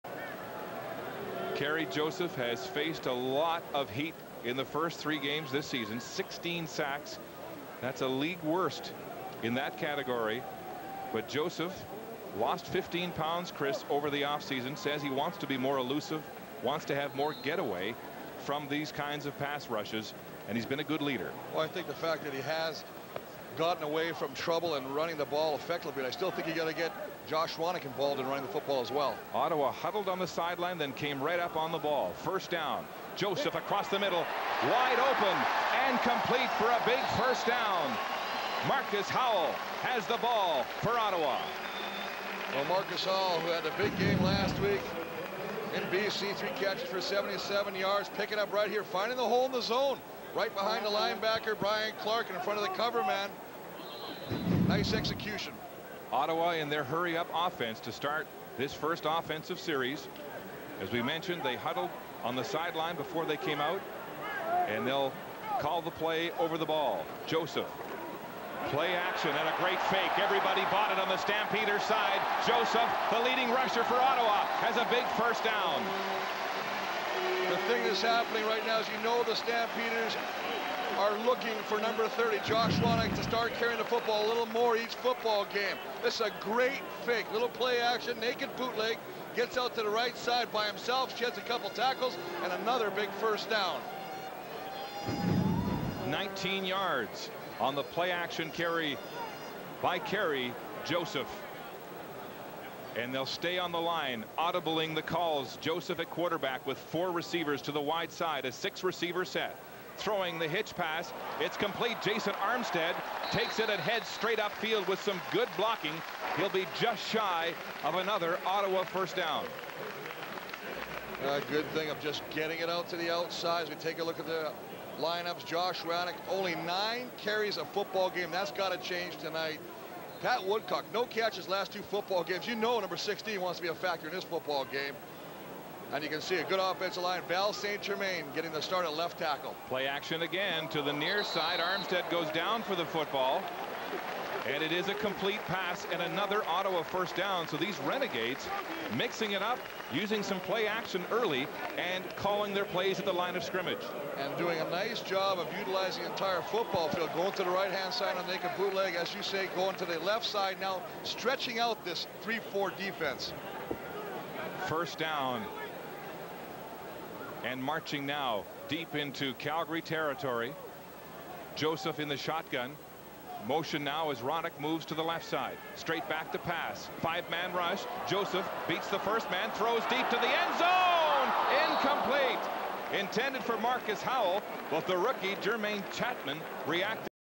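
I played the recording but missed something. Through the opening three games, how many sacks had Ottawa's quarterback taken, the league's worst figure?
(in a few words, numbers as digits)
16.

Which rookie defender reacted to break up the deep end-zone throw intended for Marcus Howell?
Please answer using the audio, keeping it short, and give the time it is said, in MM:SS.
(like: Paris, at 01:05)
Jermaine Chapman, at 03:05.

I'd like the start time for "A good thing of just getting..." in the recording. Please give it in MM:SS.
02:01.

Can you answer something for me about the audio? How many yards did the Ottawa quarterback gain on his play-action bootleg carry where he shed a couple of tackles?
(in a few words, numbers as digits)
19.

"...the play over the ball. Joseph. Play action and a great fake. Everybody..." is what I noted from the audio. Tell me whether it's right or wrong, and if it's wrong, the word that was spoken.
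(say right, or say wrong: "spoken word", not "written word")
right.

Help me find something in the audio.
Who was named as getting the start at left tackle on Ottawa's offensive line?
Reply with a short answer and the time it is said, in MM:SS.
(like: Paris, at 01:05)
Val St. Germain, at 02:17.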